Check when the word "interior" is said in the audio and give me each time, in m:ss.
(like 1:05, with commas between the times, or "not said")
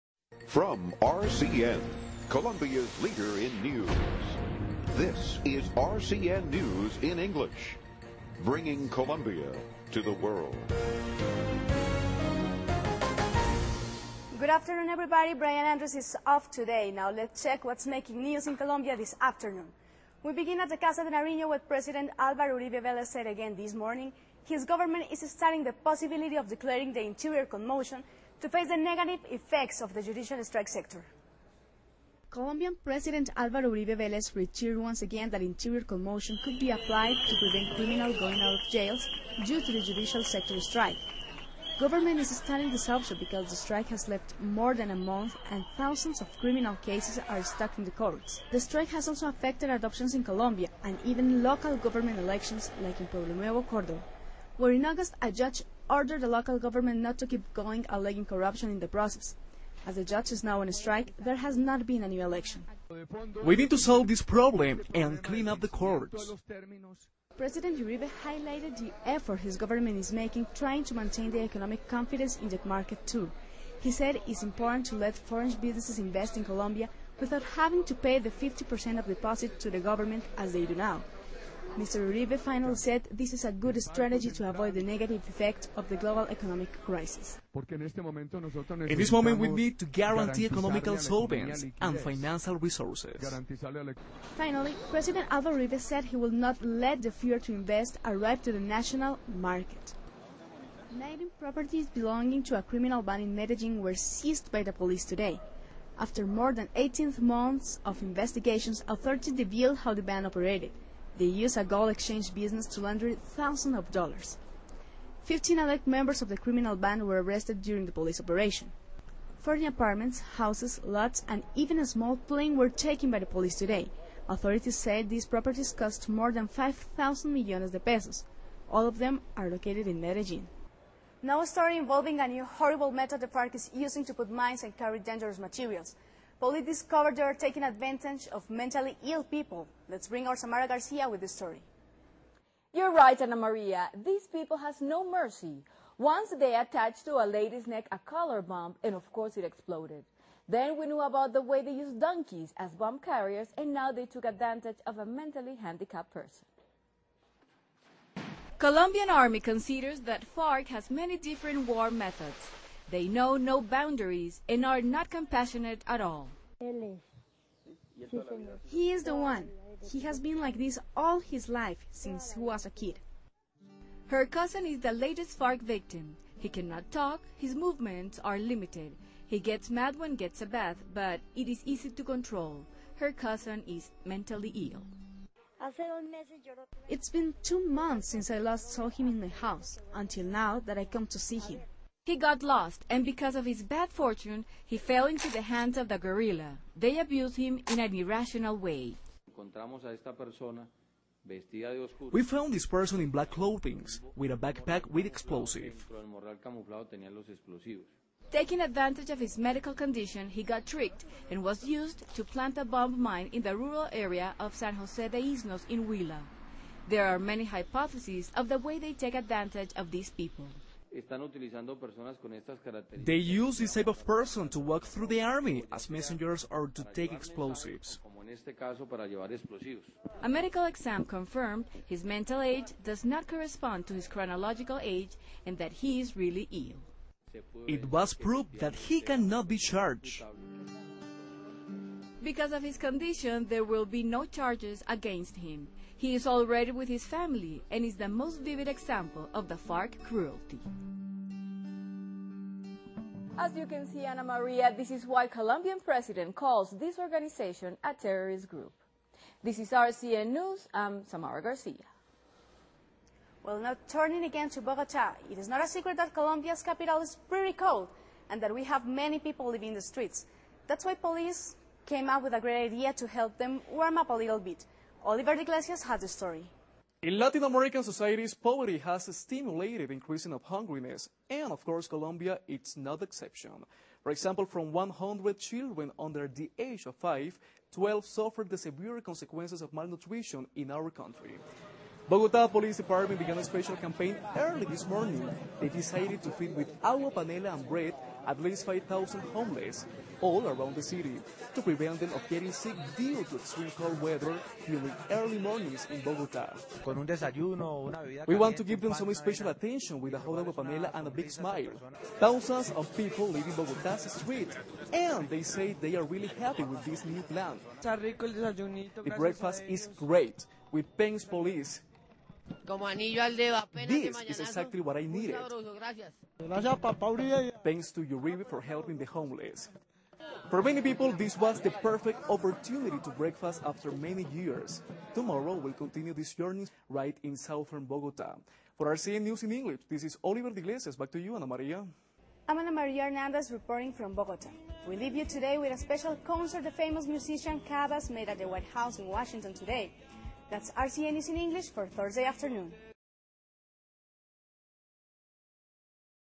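0:27, 0:35.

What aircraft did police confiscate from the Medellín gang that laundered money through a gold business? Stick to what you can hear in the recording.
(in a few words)
small plane.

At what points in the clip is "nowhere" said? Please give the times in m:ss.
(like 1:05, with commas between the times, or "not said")
not said.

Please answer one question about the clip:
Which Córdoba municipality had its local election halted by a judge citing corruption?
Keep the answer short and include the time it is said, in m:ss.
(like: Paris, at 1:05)
Pueblo Nuevo, at 0:53.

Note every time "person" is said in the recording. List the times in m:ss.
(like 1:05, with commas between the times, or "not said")
2:36, 3:22, 3:44.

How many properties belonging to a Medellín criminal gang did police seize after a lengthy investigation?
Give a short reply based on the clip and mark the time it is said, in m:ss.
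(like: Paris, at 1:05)
19, at 1:40.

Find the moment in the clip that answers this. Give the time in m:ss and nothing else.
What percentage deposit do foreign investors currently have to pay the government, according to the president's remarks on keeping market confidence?
1:18.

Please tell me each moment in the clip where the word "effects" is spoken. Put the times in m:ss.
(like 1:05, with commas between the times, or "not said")
0:29, 1:25.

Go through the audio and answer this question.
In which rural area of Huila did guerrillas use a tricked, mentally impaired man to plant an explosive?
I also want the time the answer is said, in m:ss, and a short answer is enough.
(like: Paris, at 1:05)
San Jose de Isnos, at 3:34.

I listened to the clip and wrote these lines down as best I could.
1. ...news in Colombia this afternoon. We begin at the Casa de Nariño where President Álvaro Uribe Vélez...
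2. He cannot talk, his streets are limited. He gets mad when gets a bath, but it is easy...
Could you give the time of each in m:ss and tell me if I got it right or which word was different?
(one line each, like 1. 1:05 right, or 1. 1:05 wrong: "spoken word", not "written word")
1. 0:18 right
2. 2:56 wrong: "movements", not "streets".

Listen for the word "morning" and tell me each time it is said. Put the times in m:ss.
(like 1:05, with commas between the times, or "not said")
0:23, 4:54, 5:05.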